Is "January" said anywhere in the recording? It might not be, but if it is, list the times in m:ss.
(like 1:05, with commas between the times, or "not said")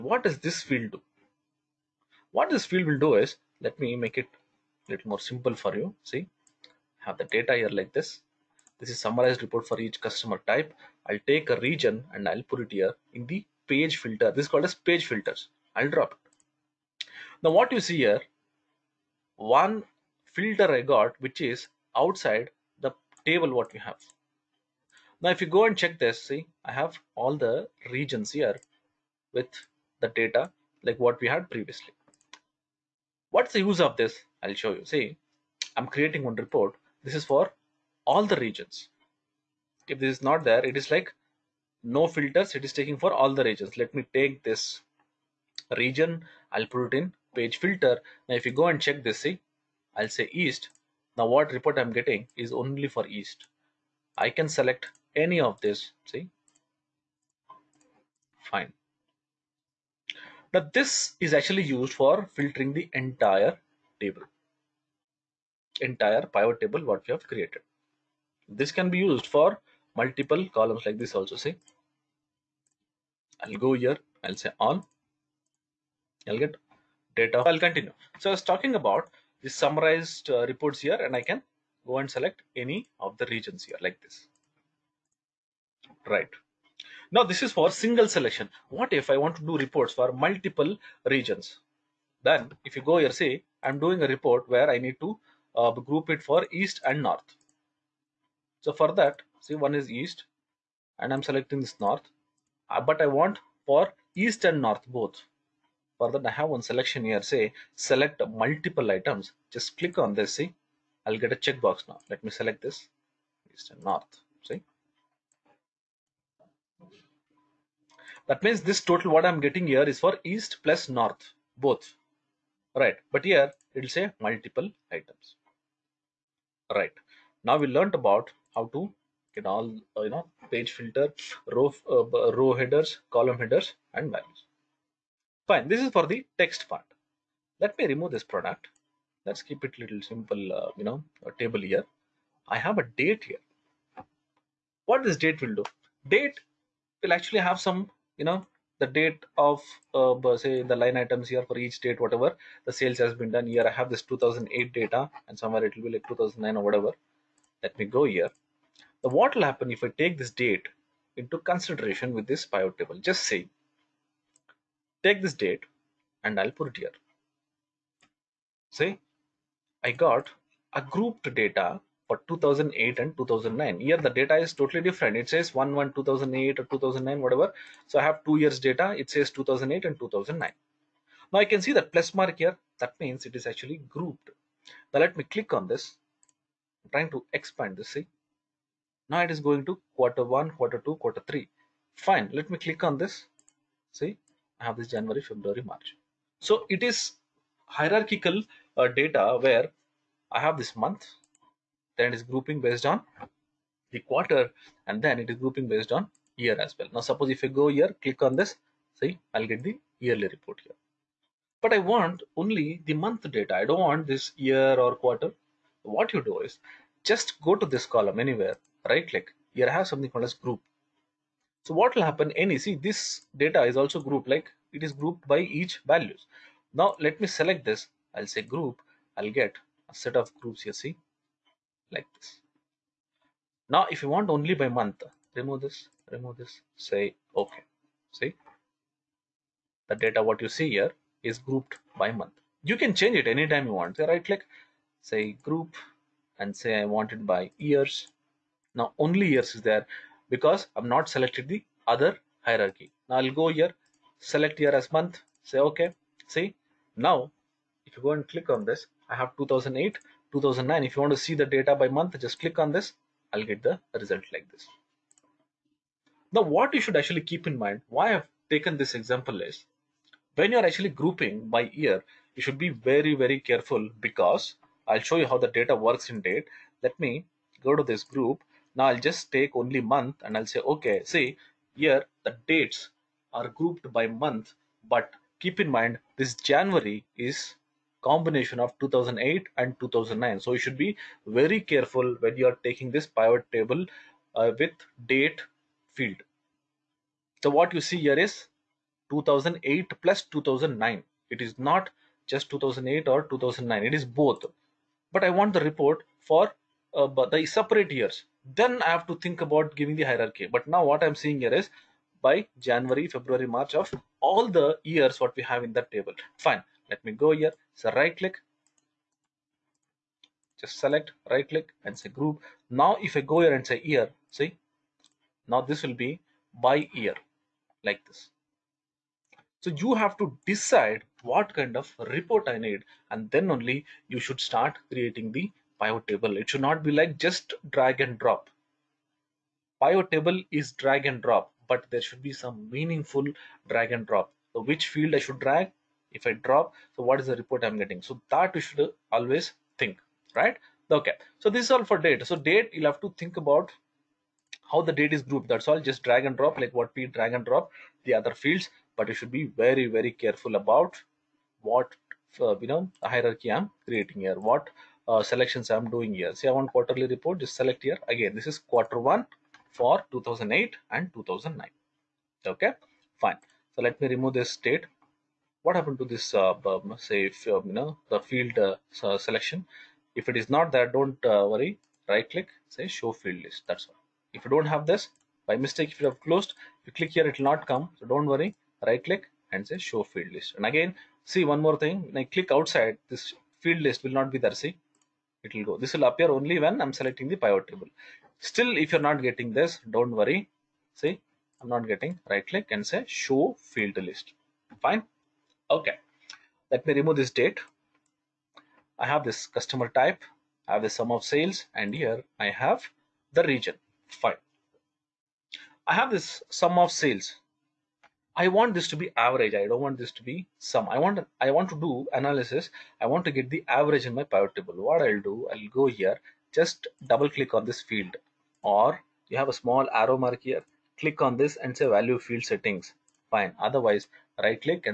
3:14, 4:46, 5:12.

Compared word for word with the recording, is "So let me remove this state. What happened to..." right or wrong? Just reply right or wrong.
right.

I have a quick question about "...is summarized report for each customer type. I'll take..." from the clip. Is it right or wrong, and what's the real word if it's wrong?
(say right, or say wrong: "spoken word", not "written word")
right.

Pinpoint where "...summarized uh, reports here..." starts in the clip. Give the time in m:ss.
1:19.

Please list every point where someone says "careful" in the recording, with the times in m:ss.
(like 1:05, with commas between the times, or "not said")
4:33, 4:51, 6:00.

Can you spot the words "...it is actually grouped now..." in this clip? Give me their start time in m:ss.
3:03.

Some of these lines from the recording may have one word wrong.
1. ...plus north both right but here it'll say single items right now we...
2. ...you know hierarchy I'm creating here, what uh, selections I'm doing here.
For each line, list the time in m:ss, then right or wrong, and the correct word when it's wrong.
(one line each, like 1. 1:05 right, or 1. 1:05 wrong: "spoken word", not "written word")
1. 2:00 wrong: "multiple", not "single"
2. 6:02 right.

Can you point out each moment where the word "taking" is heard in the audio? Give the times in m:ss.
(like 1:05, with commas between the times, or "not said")
0:42, 4:52.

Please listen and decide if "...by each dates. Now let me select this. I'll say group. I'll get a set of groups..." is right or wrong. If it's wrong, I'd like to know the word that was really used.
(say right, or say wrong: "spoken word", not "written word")
wrong: "values", not "dates".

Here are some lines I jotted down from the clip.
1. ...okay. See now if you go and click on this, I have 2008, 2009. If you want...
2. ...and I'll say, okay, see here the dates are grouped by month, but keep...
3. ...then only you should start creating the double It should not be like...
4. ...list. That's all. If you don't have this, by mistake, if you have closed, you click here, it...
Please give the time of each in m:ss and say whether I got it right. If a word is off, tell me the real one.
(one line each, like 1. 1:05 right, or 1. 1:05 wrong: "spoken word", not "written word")
1. 4:15 right
2. 4:40 right
3. 5:33 wrong: "table", not "double"
4. 6:23 right.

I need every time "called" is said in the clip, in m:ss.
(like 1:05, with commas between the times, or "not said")
0:14, 3:40.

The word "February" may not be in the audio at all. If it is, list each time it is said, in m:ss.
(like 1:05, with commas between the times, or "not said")
3:15, 5:13.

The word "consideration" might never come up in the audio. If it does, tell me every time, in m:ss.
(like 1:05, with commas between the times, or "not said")
2:41.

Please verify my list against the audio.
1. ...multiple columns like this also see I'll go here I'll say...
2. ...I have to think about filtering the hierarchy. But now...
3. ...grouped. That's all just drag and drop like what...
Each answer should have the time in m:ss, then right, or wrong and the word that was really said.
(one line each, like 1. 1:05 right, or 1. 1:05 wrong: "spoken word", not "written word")
1. 1:09 right
2. 5:08 wrong: "giving", not "filtering"
3. 5:55 right.